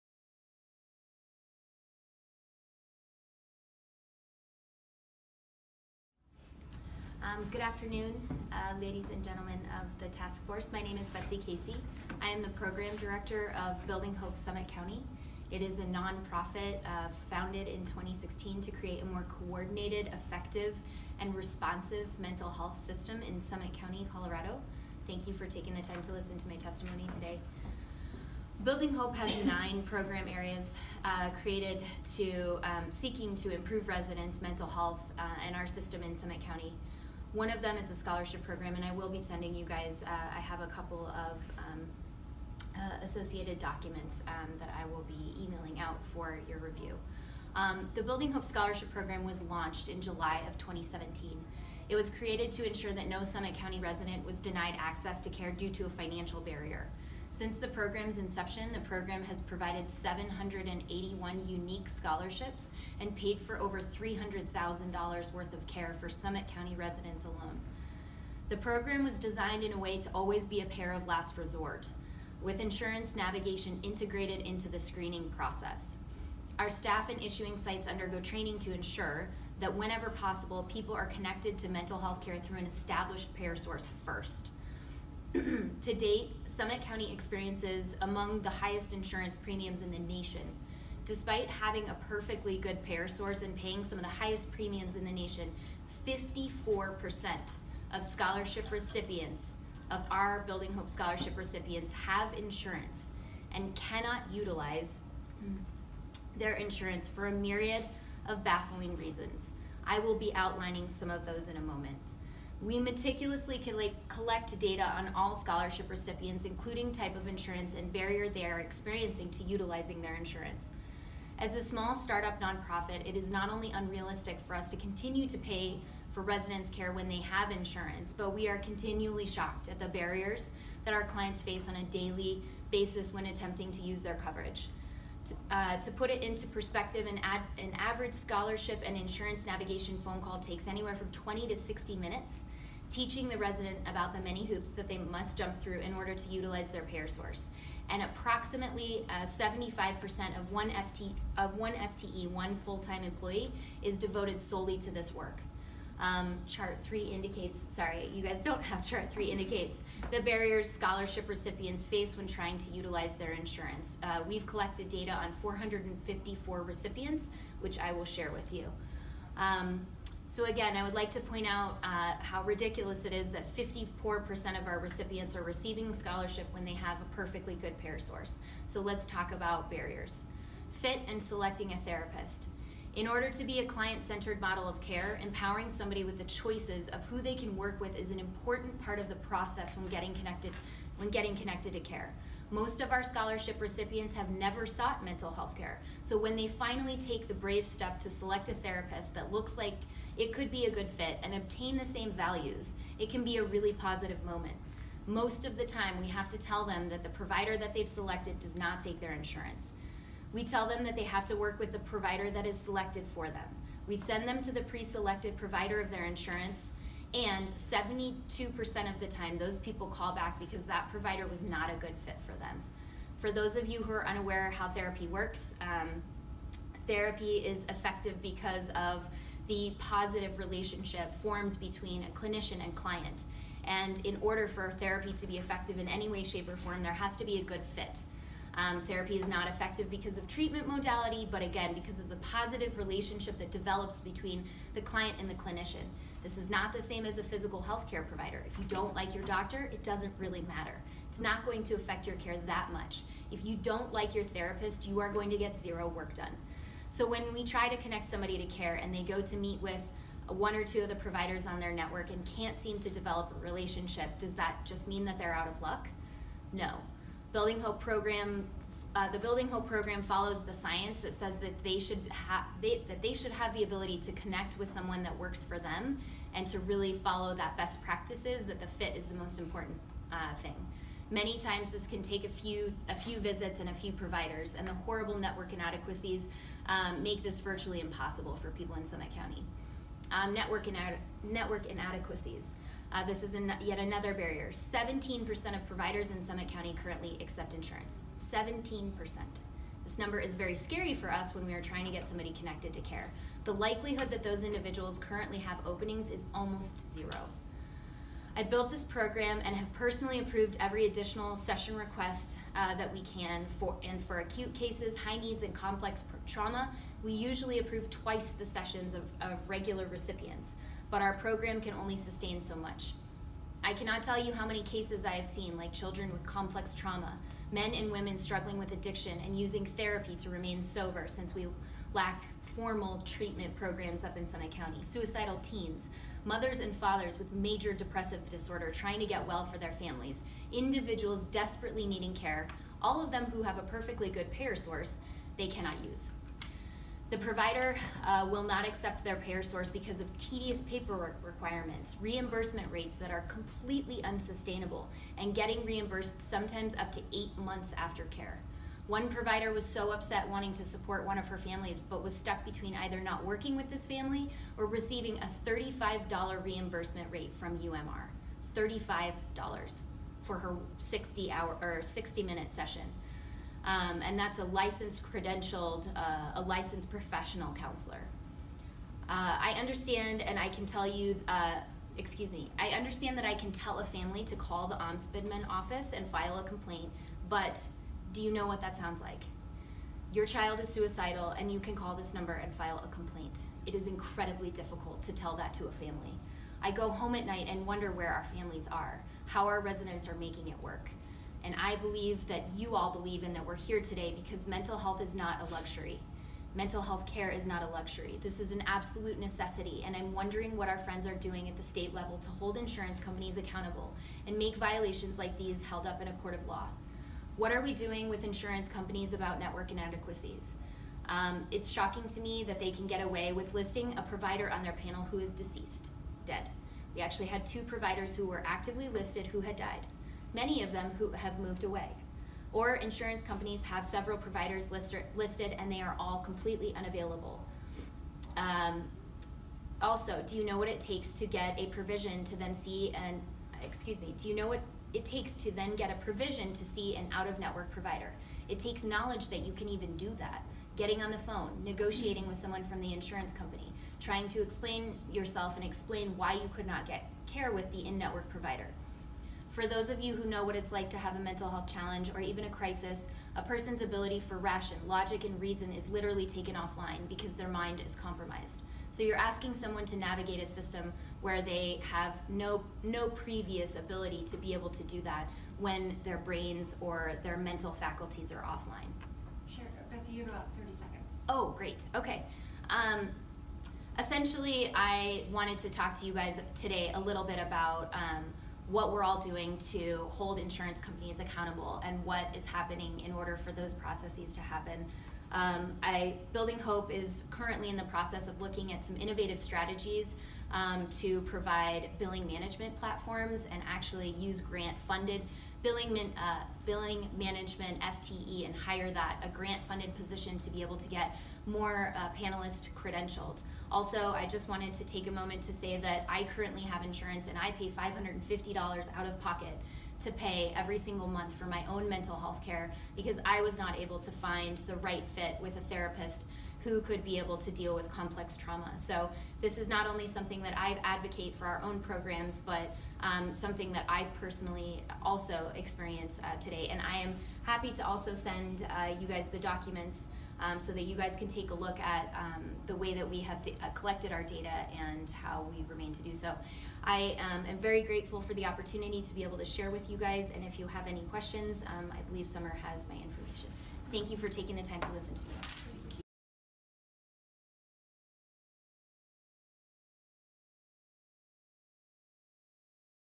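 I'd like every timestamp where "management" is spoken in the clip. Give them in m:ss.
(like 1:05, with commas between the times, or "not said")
8:22, 8:27.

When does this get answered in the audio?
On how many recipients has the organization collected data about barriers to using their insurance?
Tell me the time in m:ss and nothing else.
2:45.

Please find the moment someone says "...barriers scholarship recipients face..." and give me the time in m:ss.
2:40.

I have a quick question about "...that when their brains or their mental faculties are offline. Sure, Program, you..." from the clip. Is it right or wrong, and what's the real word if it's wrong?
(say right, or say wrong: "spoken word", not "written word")
wrong: "Betsy", not "Program".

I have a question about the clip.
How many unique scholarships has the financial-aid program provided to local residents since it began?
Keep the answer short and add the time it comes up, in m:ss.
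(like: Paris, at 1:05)
781, at 0:59.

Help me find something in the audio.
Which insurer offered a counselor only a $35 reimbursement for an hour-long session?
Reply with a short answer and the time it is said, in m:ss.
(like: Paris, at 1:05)
UMR, at 6:07.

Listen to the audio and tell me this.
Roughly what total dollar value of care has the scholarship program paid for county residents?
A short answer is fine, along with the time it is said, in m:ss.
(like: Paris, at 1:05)
$300,000, at 1:03.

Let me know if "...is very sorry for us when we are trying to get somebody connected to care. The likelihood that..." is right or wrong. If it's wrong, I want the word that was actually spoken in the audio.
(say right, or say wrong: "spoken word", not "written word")
wrong: "scary", not "sorry".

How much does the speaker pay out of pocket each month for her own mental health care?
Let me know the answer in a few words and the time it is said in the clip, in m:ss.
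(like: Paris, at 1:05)
$550, at 8:37.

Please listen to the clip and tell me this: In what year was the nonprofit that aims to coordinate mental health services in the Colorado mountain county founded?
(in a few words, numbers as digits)
2016.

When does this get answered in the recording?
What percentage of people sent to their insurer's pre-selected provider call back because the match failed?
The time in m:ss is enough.
3:37.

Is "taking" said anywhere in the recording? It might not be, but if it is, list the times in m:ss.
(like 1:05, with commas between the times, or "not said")
0:25, 9:14.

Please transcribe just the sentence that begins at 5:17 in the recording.
We usually approve twice the sessions of, of regular recipients, but our program can only sustain so much.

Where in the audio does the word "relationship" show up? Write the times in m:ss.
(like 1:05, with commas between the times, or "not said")
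3:50, 4:02, 4:23.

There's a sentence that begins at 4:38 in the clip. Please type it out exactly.
That the fit is the most important uh, thing.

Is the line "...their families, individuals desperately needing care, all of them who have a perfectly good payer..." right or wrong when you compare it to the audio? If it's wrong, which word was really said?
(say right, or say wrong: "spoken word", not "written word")
right.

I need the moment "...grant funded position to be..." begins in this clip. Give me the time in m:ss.
8:29.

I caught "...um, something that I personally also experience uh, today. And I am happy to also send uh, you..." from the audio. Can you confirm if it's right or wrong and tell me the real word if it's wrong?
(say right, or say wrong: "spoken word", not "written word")
right.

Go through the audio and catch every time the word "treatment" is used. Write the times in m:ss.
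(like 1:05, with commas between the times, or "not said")
4:00, 5:33.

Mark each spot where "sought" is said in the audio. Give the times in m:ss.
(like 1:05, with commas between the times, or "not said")
3:14.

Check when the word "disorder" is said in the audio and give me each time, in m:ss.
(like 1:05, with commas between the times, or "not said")
5:38.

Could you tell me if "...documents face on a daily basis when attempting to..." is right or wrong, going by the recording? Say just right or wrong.
wrong.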